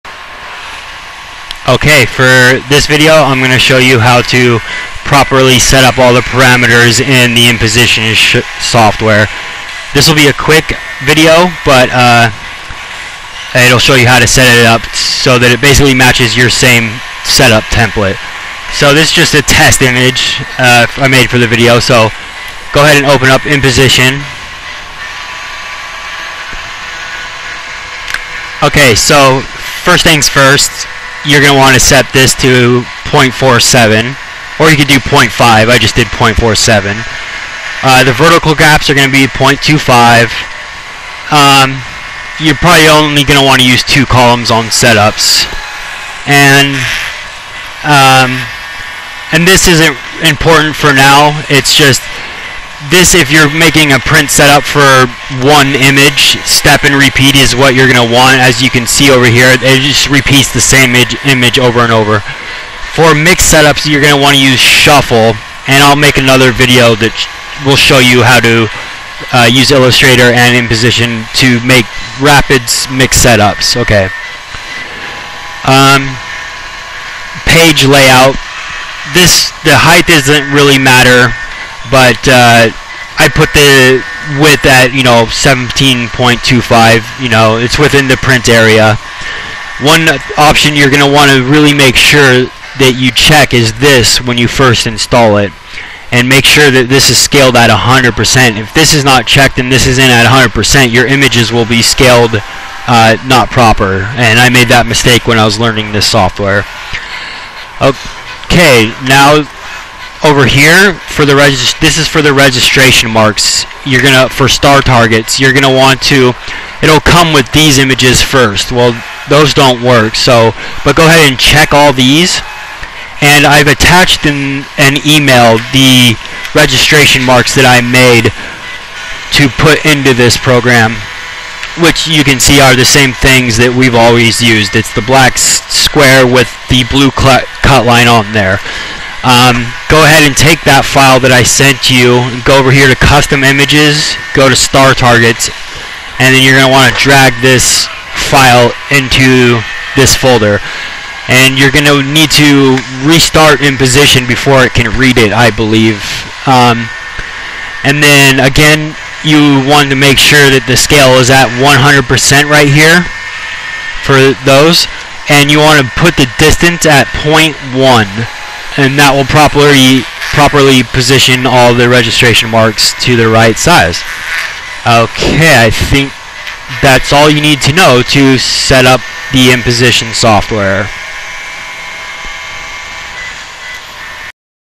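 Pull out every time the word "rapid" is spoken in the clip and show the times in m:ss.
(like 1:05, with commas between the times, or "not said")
1:12.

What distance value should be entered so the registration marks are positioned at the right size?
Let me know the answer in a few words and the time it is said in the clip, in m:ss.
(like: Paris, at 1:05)
0.1, at 2:47.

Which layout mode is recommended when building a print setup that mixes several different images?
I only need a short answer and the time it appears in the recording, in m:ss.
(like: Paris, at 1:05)
shuffle, at 1:04.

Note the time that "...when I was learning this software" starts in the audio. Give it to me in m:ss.
1:45.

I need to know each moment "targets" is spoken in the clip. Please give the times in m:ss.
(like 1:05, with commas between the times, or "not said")
1:54, 2:24.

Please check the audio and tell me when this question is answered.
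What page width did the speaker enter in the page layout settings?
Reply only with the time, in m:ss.
1:25.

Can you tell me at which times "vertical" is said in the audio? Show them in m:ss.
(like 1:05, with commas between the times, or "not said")
0:38.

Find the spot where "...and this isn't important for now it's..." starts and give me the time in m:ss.
0:49.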